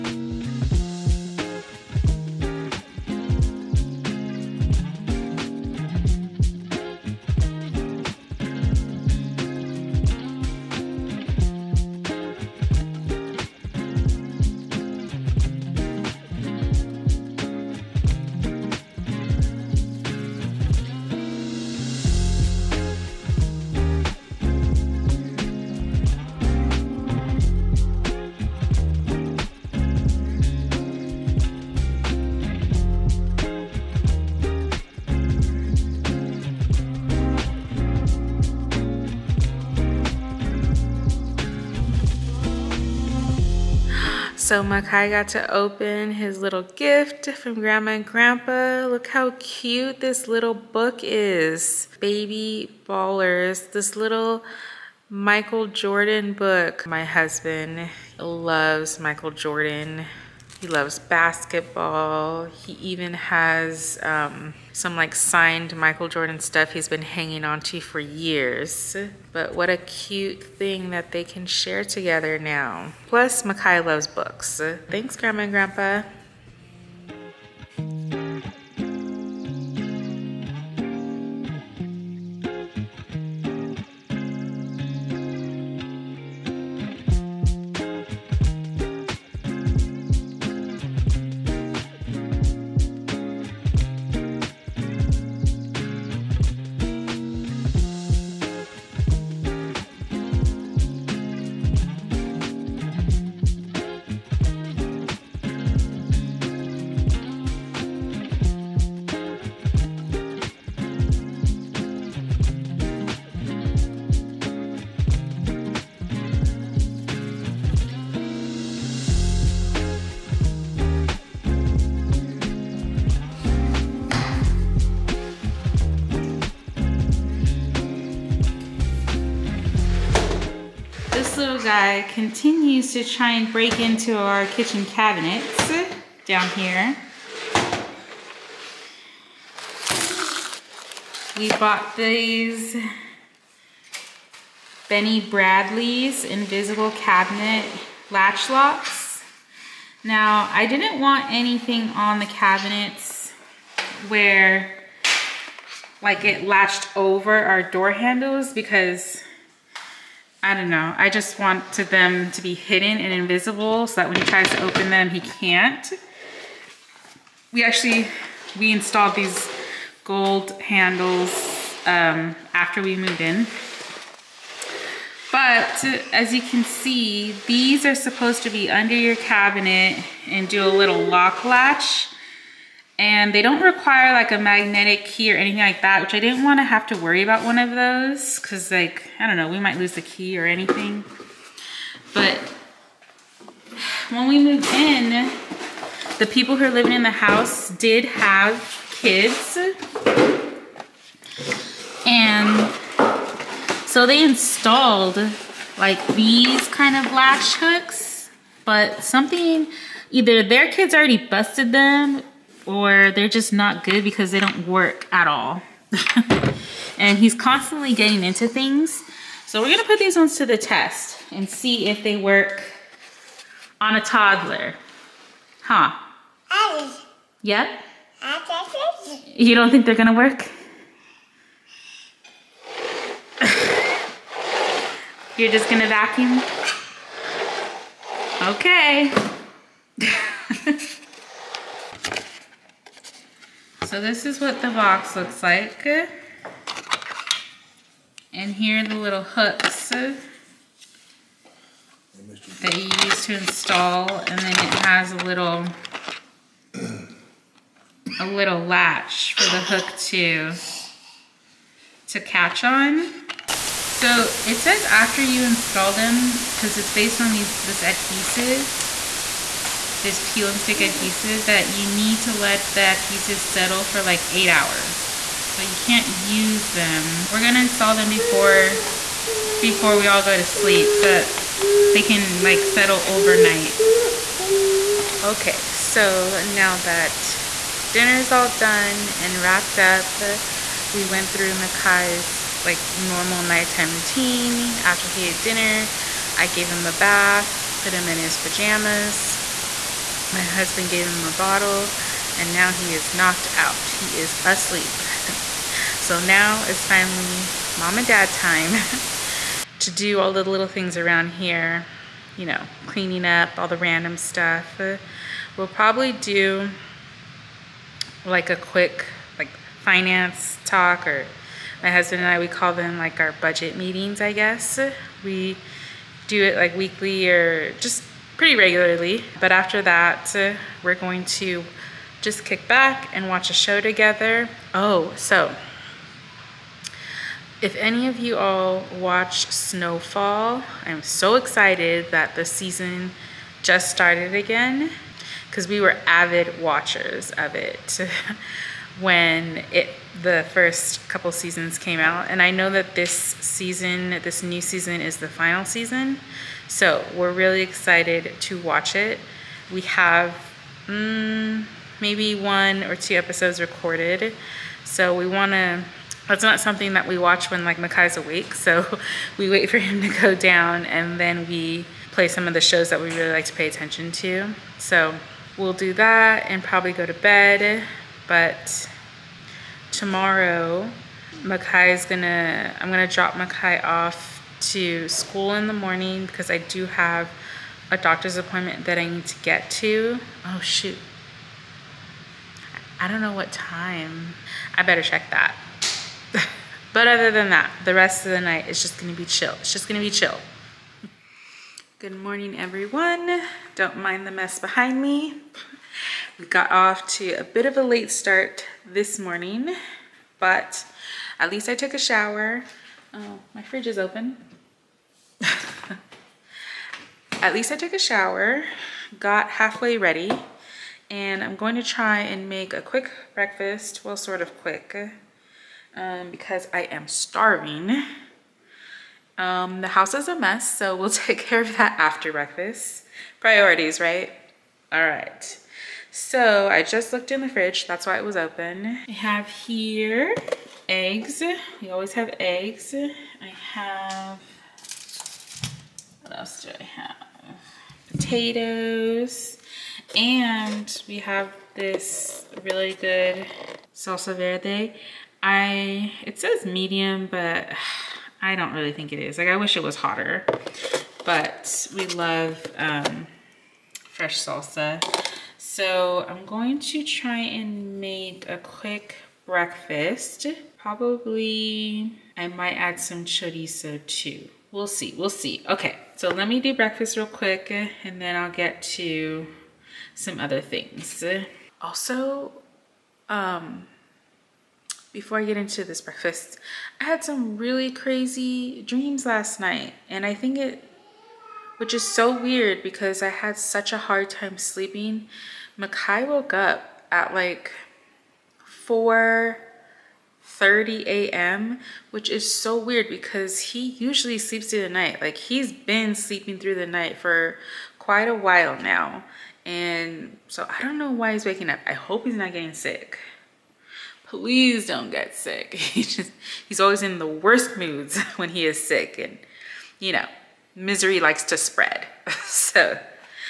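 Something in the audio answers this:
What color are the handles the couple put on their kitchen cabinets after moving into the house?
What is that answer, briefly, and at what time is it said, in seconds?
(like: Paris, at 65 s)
gold, at 170 s.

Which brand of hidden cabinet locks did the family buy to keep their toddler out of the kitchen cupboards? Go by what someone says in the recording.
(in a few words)
Benny Bradley's.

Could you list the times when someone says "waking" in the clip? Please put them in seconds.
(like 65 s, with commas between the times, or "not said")
511 s.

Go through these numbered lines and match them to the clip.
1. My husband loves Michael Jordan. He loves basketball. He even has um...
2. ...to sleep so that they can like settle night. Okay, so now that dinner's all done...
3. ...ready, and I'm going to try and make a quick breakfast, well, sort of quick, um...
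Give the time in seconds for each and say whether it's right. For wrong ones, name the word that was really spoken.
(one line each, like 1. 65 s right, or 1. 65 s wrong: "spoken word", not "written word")
1. 56 s right
2. 280 s wrong: "overnight", not "night"
3. 419 s right.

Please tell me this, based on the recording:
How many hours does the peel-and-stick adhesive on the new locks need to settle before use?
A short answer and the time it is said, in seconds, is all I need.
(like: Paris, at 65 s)
8, at 274 s.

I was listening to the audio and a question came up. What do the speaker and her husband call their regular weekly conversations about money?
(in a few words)
budget meetings.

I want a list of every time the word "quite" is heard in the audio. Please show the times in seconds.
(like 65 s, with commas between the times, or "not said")
507 s.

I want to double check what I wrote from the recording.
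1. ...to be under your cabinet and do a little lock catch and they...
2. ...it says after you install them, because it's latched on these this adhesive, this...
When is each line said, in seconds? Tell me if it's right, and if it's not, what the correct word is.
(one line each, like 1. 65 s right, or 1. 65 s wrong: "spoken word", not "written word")
1. 178 s wrong: "latch", not "catch"
2. 264 s wrong: "based", not "latched".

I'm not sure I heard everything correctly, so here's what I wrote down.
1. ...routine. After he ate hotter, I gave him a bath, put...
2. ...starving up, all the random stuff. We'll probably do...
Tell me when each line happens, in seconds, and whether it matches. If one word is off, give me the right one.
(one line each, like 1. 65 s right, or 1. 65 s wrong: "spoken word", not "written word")
1. 293 s wrong: "dinner", not "hotter"
2. 312 s wrong: "cleaning", not "starving".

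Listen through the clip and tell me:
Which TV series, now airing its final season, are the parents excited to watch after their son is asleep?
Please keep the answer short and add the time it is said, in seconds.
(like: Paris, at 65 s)
Snowfall, at 339 s.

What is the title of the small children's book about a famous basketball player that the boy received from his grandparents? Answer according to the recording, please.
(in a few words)
Baby Ballers.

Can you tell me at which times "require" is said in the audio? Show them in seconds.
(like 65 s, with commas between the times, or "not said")
183 s.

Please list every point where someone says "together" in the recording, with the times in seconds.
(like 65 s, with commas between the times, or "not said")
71 s, 333 s.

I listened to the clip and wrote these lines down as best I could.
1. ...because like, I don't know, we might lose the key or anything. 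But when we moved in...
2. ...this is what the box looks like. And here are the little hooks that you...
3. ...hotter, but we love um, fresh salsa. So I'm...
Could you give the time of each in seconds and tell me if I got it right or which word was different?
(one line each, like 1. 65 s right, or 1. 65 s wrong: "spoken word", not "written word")
1. 188 s right
2. 244 s right
3. 459 s right.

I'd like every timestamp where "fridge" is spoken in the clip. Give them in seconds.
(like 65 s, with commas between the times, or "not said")
413 s, 437 s.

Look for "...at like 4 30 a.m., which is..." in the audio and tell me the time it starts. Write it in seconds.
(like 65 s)
497 s.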